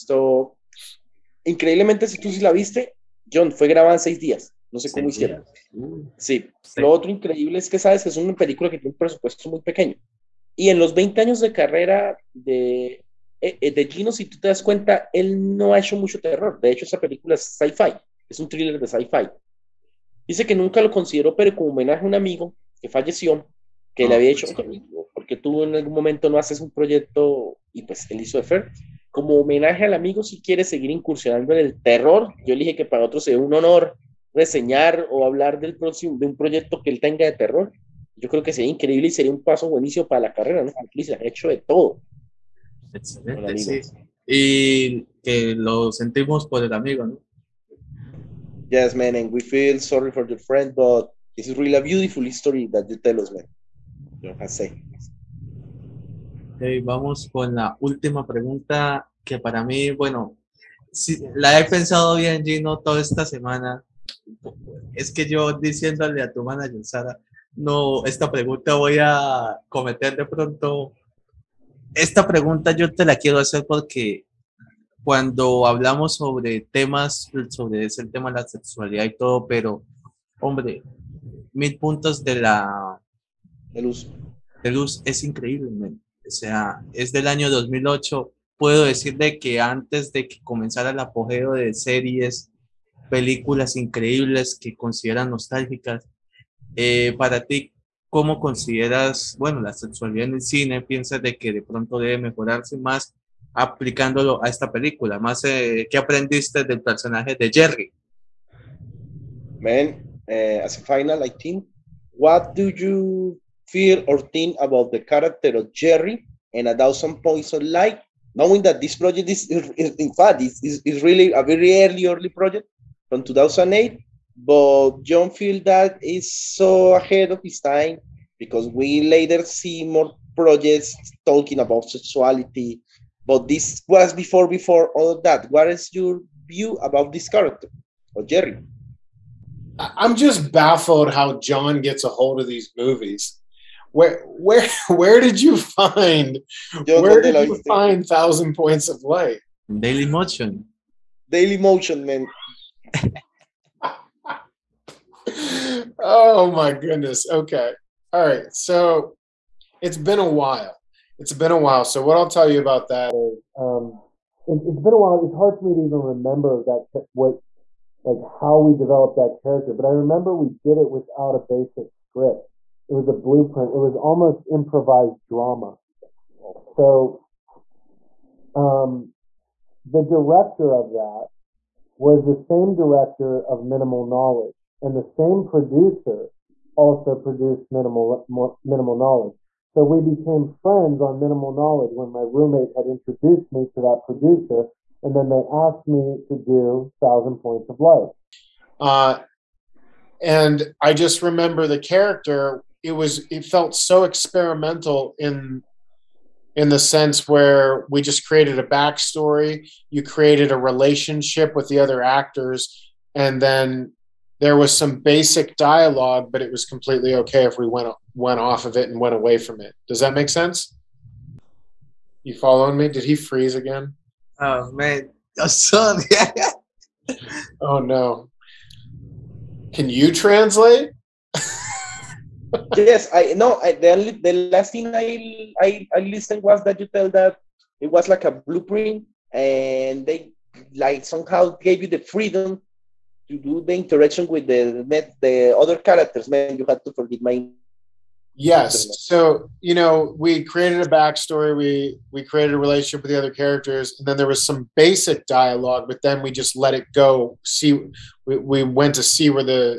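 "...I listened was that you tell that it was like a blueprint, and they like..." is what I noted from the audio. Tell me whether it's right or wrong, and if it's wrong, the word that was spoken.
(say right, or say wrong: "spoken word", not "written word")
right.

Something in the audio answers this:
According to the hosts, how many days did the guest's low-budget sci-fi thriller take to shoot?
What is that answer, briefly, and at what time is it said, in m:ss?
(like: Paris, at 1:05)
6, at 0:04.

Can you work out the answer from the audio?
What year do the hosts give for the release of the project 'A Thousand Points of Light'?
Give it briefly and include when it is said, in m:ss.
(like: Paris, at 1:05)
2008, at 1:27.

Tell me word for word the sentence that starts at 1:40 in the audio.
¿Piensas de que de pronto debe mejorarse más aplicándolo a esta película?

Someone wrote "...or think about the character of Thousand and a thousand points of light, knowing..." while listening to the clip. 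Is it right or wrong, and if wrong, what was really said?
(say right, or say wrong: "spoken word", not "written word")
wrong: "Jerry", not "Thousand".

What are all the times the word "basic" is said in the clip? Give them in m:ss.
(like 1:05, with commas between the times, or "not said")
2:51, 3:35, 4:14.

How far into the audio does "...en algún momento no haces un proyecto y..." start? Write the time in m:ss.
0:25.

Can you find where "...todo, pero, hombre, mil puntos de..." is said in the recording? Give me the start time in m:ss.
1:19.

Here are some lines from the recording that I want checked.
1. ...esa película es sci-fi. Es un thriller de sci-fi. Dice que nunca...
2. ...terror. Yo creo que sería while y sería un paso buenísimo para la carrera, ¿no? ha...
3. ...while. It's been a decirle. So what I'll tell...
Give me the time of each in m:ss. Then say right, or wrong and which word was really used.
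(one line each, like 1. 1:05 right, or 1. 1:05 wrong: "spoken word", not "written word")
1. 0:16 right
2. 0:37 wrong: "increíble", not "while"
3. 2:40 wrong: "while", not "decirle".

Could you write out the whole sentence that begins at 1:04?
Es que yo diciéndole a tu manager, Sara, no, esta pregunta voy a cometer de pronto.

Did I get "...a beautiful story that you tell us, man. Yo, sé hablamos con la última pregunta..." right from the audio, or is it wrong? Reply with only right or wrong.
wrong.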